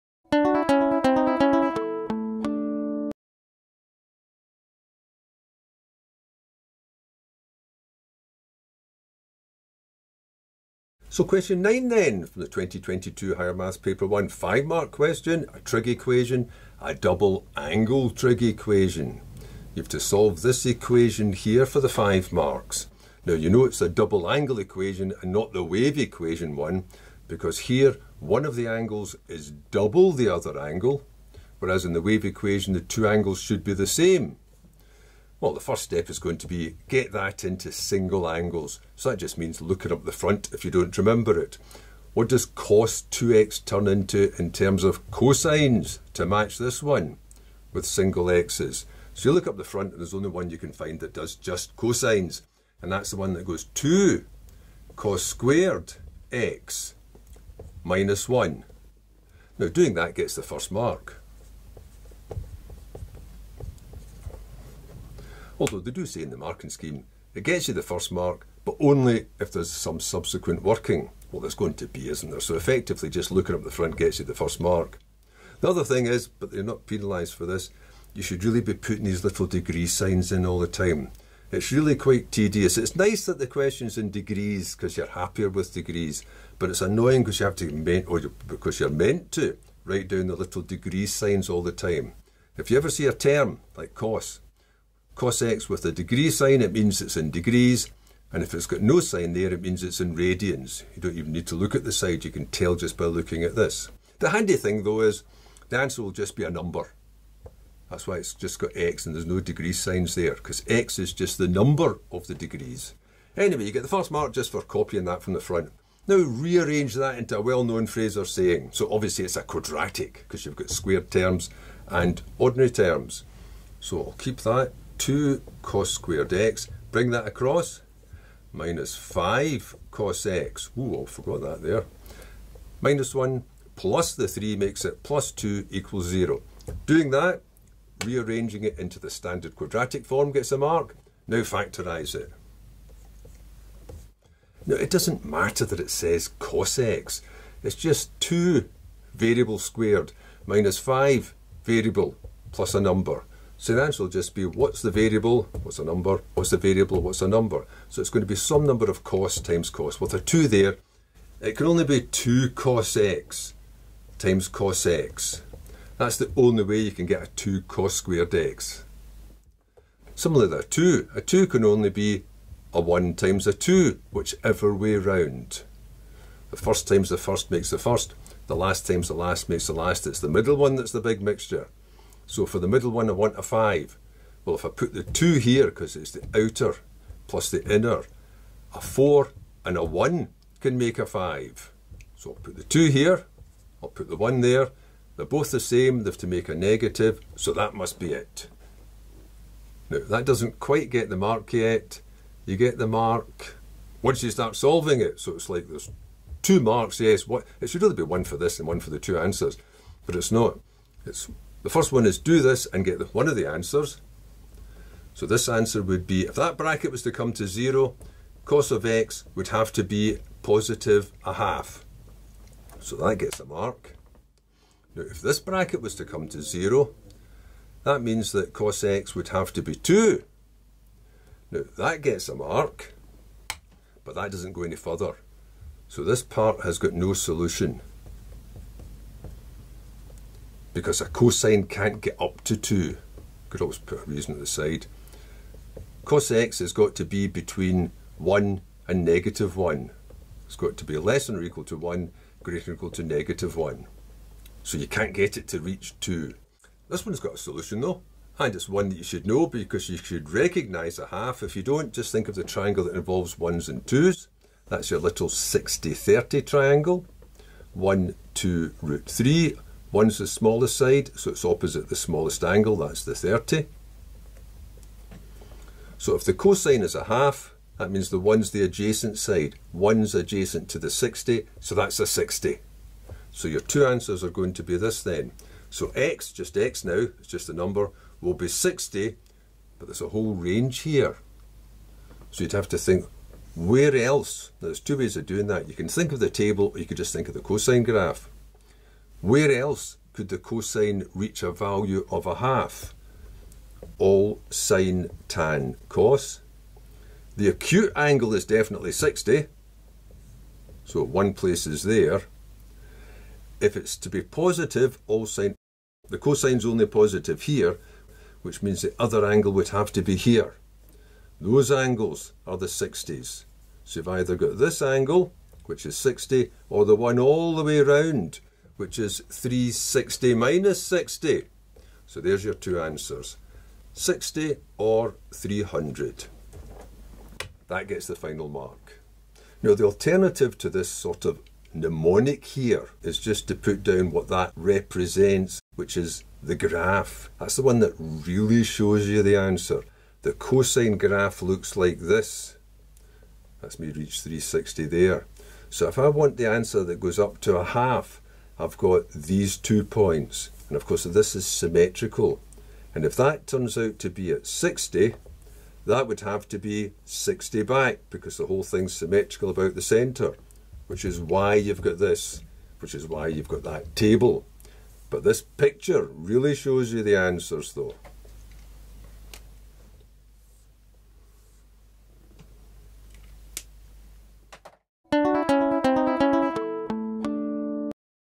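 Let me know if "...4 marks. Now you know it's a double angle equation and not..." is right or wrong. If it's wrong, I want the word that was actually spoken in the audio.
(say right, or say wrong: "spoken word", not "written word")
wrong: "5", not "4".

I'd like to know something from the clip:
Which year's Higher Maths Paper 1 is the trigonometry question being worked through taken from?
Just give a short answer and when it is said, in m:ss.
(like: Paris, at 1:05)
2022, at 0:12.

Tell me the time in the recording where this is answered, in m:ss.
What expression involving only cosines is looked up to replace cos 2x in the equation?
0:53.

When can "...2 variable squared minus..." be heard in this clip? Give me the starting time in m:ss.
2:28.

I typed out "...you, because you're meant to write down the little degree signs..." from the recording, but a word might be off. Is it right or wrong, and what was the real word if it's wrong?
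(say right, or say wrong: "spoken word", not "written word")
right.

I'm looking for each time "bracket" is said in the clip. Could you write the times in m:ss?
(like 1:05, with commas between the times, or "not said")
3:36, 3:45.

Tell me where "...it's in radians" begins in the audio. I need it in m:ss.
1:39.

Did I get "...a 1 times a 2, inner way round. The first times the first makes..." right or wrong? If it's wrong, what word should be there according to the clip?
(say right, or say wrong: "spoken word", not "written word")
wrong: "whichever", not "inner".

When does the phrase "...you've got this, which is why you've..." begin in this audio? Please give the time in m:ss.
6:11.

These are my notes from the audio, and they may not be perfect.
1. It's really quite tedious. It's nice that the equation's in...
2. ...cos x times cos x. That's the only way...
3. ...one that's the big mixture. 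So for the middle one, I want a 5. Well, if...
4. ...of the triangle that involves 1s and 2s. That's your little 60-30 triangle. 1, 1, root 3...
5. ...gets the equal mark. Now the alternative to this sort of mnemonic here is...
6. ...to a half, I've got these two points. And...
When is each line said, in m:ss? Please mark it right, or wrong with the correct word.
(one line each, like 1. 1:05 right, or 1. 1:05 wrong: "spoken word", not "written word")
1. 1:21 wrong: "question", not "equation"
2. 2:42 right
3. 3:00 right
4. 4:22 wrong: "2", not "1"
5. 5:37 wrong: "final", not "equal"
6. 5:57 right.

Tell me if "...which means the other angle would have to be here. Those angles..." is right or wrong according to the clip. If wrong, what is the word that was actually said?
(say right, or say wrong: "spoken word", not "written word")
right.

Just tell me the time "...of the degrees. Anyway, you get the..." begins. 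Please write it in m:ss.
1:52.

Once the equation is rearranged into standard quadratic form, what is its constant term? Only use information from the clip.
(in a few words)
plus 2.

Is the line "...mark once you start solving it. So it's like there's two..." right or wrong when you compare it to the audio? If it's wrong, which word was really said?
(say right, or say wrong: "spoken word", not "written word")
right.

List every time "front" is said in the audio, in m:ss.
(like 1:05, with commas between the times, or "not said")
0:40, 0:49, 1:13, 1:55.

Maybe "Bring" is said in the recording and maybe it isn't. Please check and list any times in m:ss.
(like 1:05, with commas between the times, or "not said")
2:06.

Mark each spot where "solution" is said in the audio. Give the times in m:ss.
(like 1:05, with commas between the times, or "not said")
3:57, 4:17.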